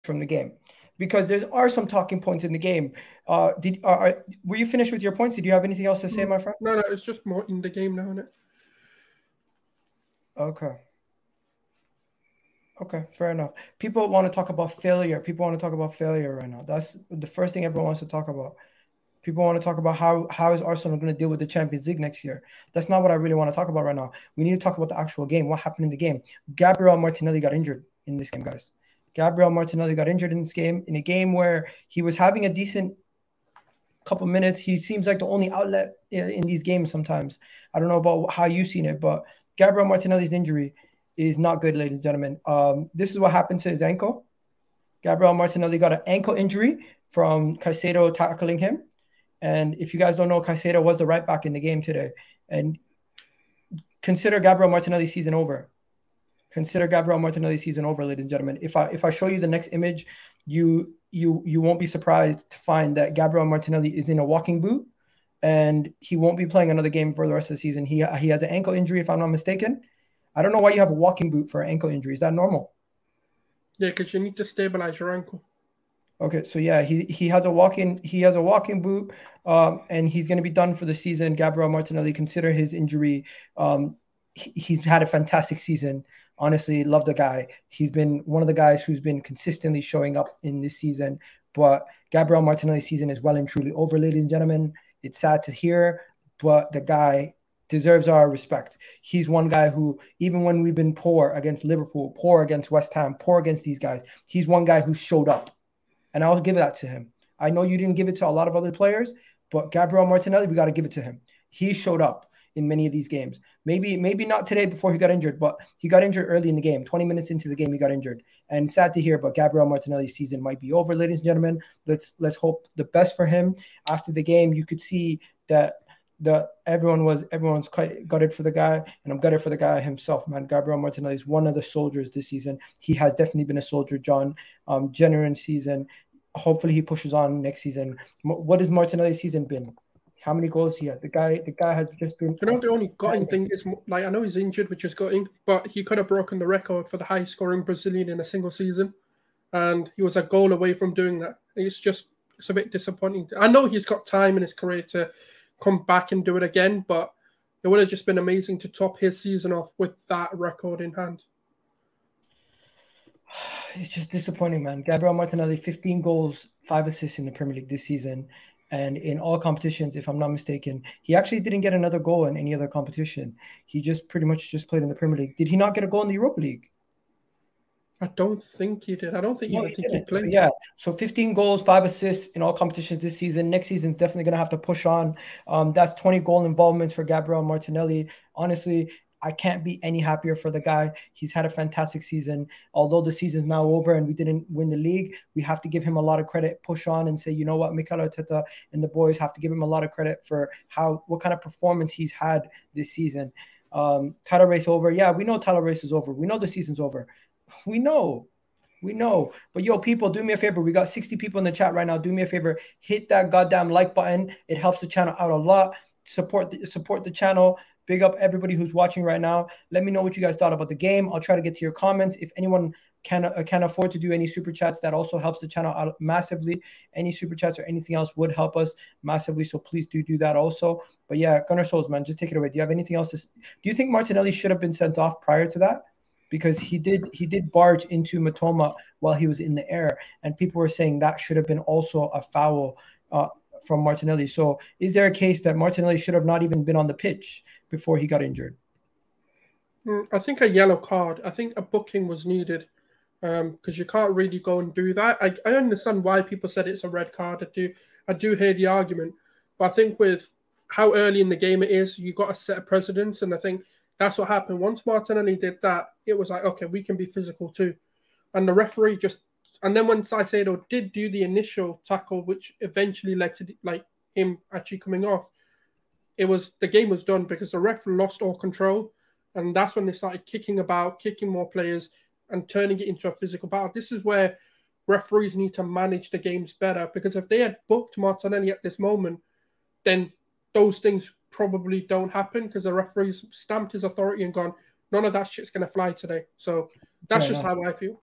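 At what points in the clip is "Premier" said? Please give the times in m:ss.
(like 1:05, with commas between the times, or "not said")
2:47, 2:54.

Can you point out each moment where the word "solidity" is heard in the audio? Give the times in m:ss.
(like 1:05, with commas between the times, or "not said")
not said.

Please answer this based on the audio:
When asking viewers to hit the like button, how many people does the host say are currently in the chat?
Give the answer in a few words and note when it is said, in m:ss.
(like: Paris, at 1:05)
60, at 3:30.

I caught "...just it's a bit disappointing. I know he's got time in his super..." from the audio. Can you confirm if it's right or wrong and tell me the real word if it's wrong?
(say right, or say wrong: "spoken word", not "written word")
wrong: "career", not "super".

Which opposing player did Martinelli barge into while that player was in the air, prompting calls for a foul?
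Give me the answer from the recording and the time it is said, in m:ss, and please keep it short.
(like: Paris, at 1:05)
Mitoma, at 3:58.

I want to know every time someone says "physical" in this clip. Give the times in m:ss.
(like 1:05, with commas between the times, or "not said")
4:27, 4:43.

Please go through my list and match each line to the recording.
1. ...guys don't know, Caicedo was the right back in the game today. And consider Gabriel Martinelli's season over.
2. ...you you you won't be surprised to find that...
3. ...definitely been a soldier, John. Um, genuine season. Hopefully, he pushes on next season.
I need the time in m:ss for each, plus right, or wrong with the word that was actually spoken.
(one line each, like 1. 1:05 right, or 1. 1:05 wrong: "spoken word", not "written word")
1. 0:49 right
2. 1:00 right
3. 2:13 right.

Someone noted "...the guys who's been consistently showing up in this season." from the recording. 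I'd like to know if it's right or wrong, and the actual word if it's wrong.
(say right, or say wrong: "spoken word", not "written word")
right.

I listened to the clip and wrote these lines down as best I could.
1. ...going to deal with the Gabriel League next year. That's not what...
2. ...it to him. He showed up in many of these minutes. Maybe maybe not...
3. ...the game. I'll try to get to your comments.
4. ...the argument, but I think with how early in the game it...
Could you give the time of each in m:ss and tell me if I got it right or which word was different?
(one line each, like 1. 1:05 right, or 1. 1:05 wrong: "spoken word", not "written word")
1. 0:20 wrong: "Champions", not "Gabriel"
2. 1:50 wrong: "games", not "minutes"
3. 3:40 right
4. 4:18 right.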